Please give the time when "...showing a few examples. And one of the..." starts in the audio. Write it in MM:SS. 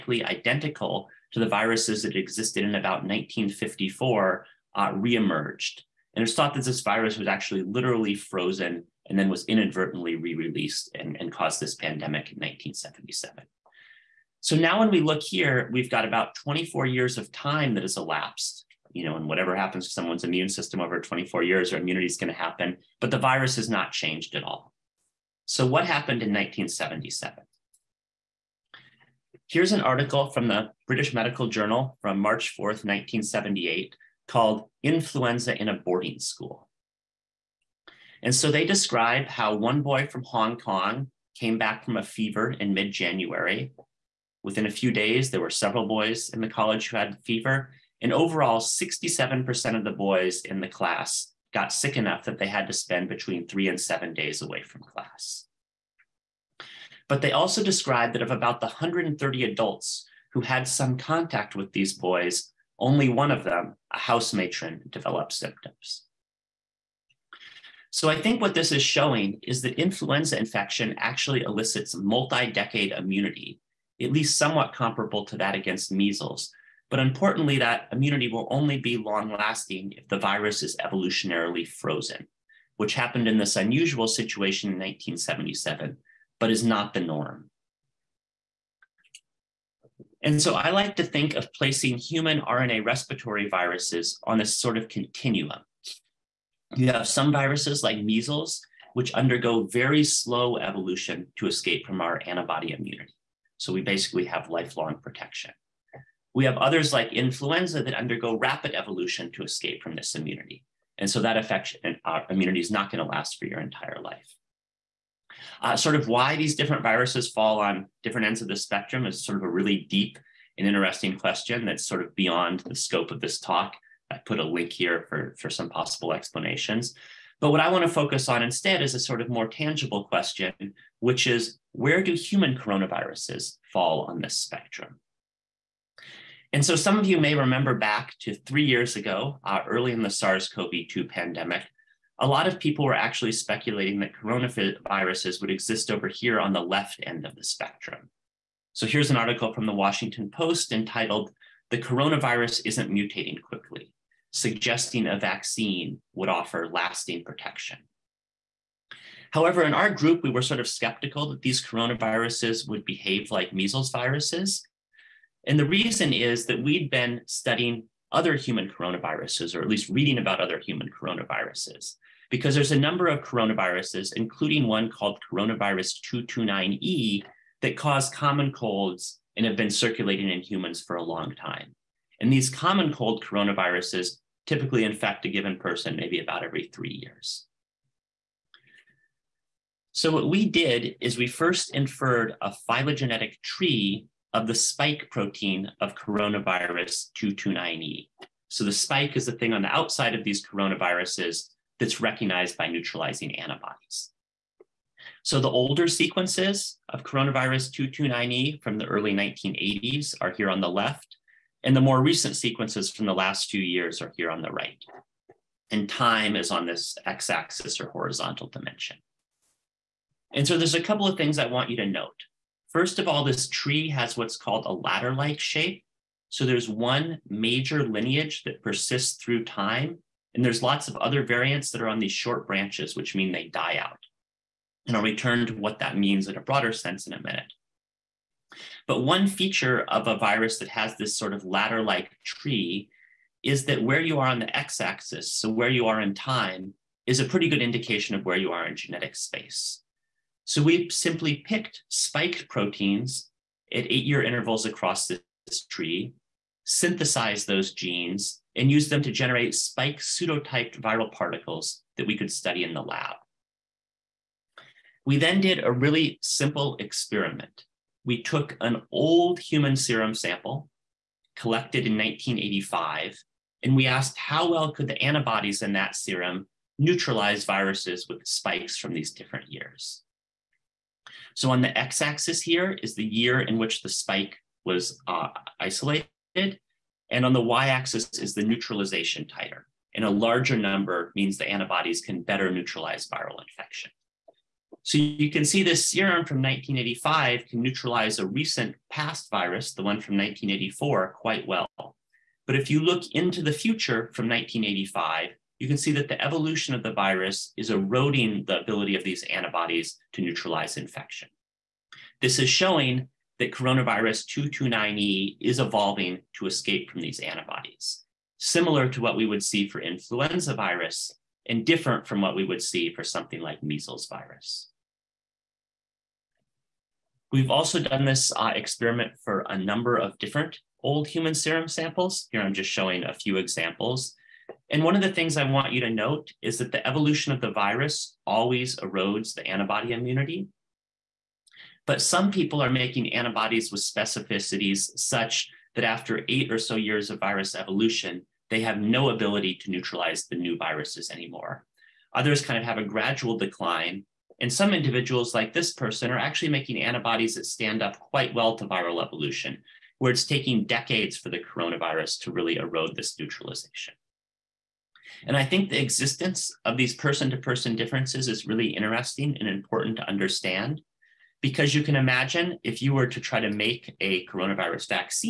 05:32.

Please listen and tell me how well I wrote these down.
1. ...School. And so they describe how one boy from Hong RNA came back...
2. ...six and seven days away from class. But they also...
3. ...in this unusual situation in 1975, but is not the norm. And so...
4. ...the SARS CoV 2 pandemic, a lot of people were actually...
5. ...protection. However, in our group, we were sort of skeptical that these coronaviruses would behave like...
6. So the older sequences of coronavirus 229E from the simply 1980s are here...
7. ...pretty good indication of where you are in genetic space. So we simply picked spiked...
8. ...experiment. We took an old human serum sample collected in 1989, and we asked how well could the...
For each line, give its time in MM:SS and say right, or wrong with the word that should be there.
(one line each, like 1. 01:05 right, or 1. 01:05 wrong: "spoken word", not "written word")
1. 00:36 wrong: "Kong", not "RNA"
2. 00:53 wrong: "three", not "six"
3. 01:23 wrong: "1977", not "1975"
4. 02:20 right
5. 02:37 right
6. 03:25 wrong: "early", not "simply"
7. 04:07 right
8. 04:26 wrong: "1985", not "1989".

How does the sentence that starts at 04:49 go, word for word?
And a larger number means the antibodies can better neutralize viral infection.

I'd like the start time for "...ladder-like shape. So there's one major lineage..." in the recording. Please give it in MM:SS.
03:44.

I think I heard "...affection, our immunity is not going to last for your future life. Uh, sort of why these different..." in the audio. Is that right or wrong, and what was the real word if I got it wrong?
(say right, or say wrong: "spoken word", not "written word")
wrong: "entire", not "future".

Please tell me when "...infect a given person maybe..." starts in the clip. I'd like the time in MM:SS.
03:04.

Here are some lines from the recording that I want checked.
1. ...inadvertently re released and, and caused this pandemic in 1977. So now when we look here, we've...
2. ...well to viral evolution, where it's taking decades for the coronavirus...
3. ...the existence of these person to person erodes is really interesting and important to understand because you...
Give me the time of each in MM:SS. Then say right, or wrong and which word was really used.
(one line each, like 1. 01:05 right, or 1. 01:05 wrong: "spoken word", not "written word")
1. 00:09 right
2. 05:58 right
3. 06:05 wrong: "differences", not "erodes".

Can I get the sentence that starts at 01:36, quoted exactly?
You have some viruses like measles, which undergo very slow evolution to escape from our antibody immunity.